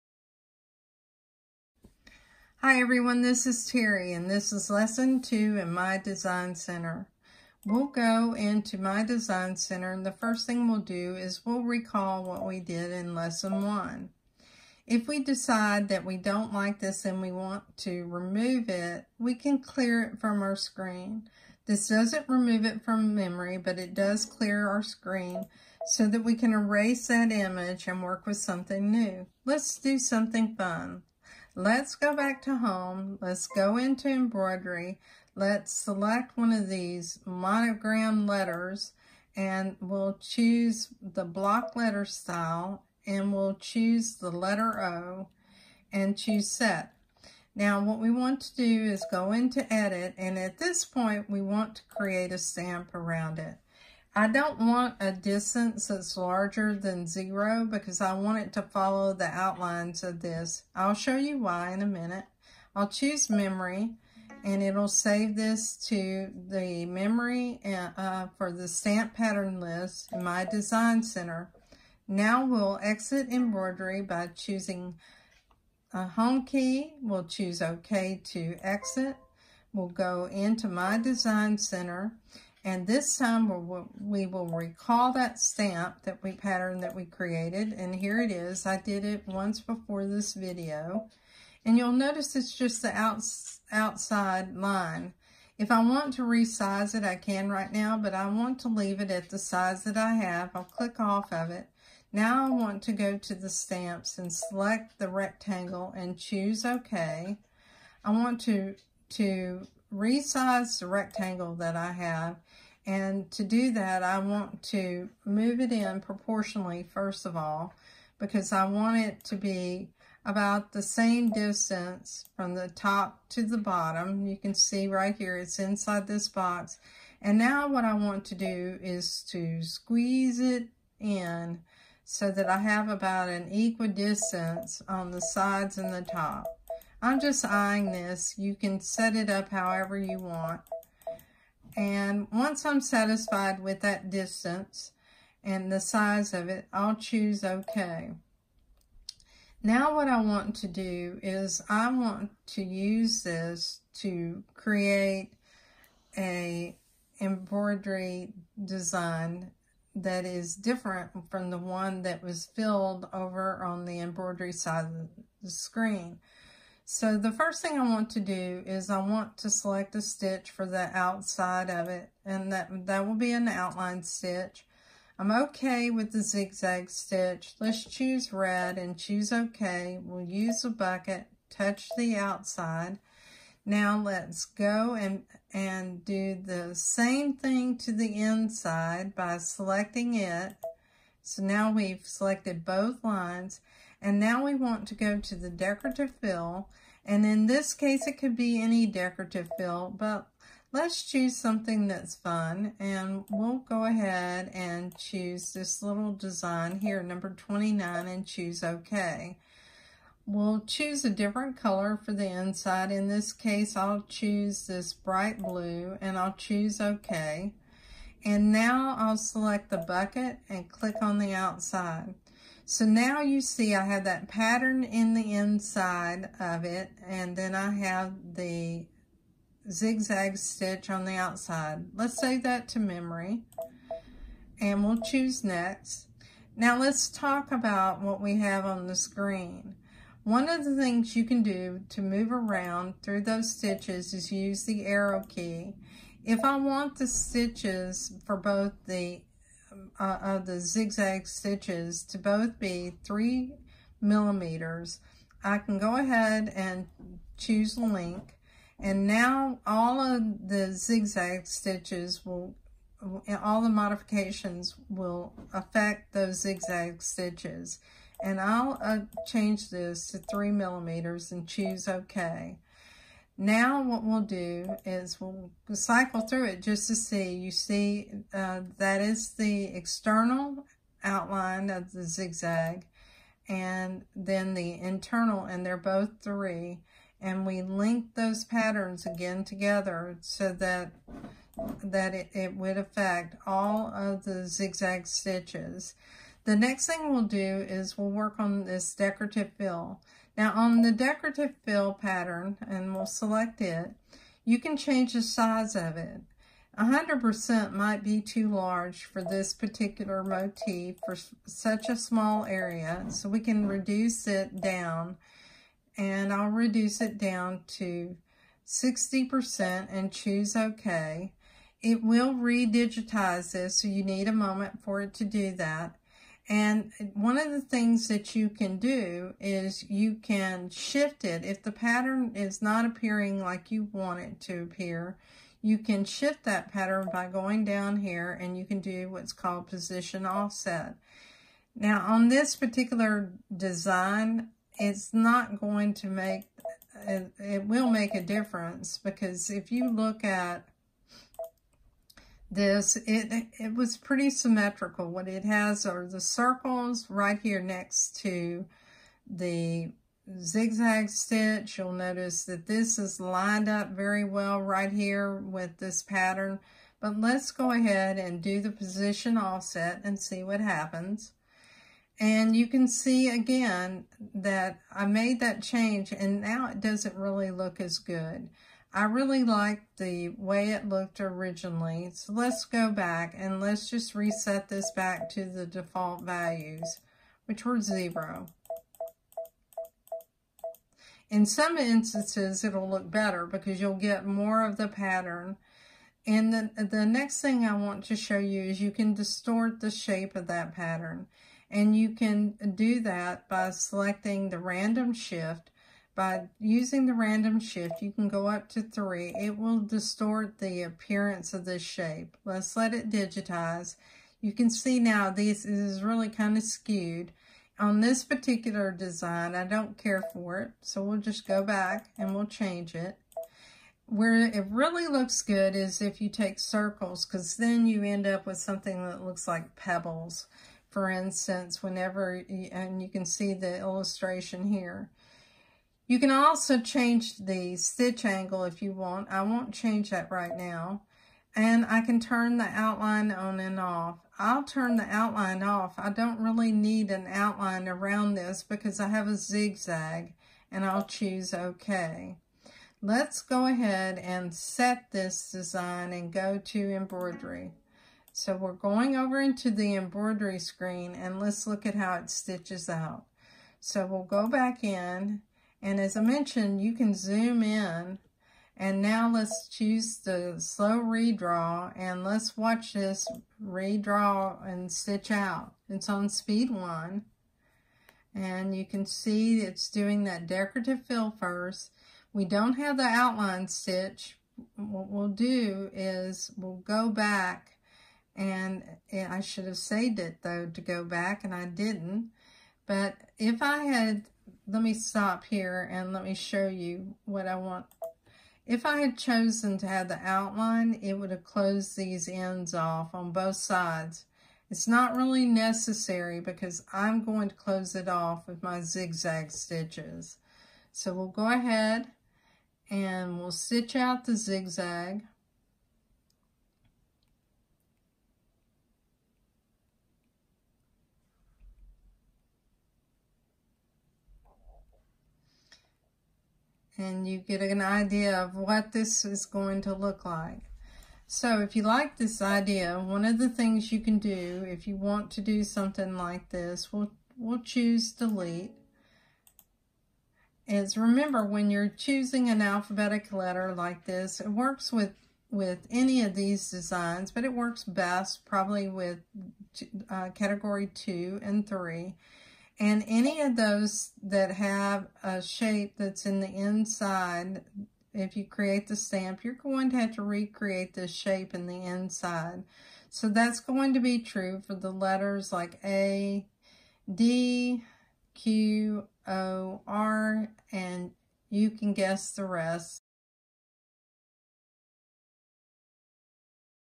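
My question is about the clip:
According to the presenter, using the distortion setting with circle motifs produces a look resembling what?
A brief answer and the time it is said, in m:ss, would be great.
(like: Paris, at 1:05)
Pebbles, at 7:09.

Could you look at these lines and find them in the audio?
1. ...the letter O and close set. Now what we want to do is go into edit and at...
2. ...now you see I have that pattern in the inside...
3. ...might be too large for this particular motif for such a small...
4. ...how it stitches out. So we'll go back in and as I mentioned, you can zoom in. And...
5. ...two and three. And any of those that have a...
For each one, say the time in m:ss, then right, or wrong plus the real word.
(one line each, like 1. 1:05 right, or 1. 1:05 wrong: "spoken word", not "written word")
1. 0:44 wrong: "choose", not "close"
2. 3:42 right
3. 5:07 right
4. 7:41 right
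5. 9:10 right.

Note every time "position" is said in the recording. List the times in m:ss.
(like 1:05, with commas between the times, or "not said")
5:39, 6:08.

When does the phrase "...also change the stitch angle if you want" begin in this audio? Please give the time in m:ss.
7:16.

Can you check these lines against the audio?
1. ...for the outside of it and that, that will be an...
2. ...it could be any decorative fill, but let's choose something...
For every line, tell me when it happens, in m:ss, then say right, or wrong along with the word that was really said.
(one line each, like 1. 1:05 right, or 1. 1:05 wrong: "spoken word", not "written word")
1. 2:50 right
2. 3:18 right.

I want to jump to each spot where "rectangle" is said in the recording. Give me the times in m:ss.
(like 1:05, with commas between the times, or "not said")
1:45, 1:50.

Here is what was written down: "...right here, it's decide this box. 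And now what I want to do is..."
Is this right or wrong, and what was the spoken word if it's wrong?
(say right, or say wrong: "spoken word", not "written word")
wrong: "inside", not "decide".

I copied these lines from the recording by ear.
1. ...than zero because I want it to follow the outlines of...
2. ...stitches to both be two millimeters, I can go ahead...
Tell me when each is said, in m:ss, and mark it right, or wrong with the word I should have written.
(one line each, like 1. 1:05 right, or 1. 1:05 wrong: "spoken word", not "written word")
1. 0:56 right
2. 4:11 wrong: "three", not "two".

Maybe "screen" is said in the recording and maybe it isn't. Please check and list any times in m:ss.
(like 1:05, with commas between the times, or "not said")
0:20, 0:24, 2:45, 3:58, 7:40.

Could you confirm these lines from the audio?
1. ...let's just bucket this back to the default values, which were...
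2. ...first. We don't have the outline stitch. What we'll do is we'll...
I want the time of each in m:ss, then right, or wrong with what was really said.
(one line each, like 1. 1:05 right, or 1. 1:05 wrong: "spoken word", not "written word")
1. 6:23 wrong: "reset", not "bucket"
2. 8:01 right.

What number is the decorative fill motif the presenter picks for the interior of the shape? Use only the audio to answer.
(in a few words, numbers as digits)
29.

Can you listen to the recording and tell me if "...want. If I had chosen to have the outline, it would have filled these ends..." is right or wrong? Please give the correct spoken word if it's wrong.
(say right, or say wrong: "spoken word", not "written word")
wrong: "closed", not "filled".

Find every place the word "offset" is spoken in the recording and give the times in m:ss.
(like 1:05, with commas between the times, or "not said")
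5:40, 6:09.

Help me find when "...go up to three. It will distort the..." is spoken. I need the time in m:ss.
6:48.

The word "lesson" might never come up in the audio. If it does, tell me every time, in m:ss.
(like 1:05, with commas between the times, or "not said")
0:04, 0:13.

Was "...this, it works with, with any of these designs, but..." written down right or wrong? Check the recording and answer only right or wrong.
right.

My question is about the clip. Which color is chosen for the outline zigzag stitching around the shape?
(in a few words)
Red.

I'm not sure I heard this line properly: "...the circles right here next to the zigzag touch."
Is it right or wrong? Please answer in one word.
wrong.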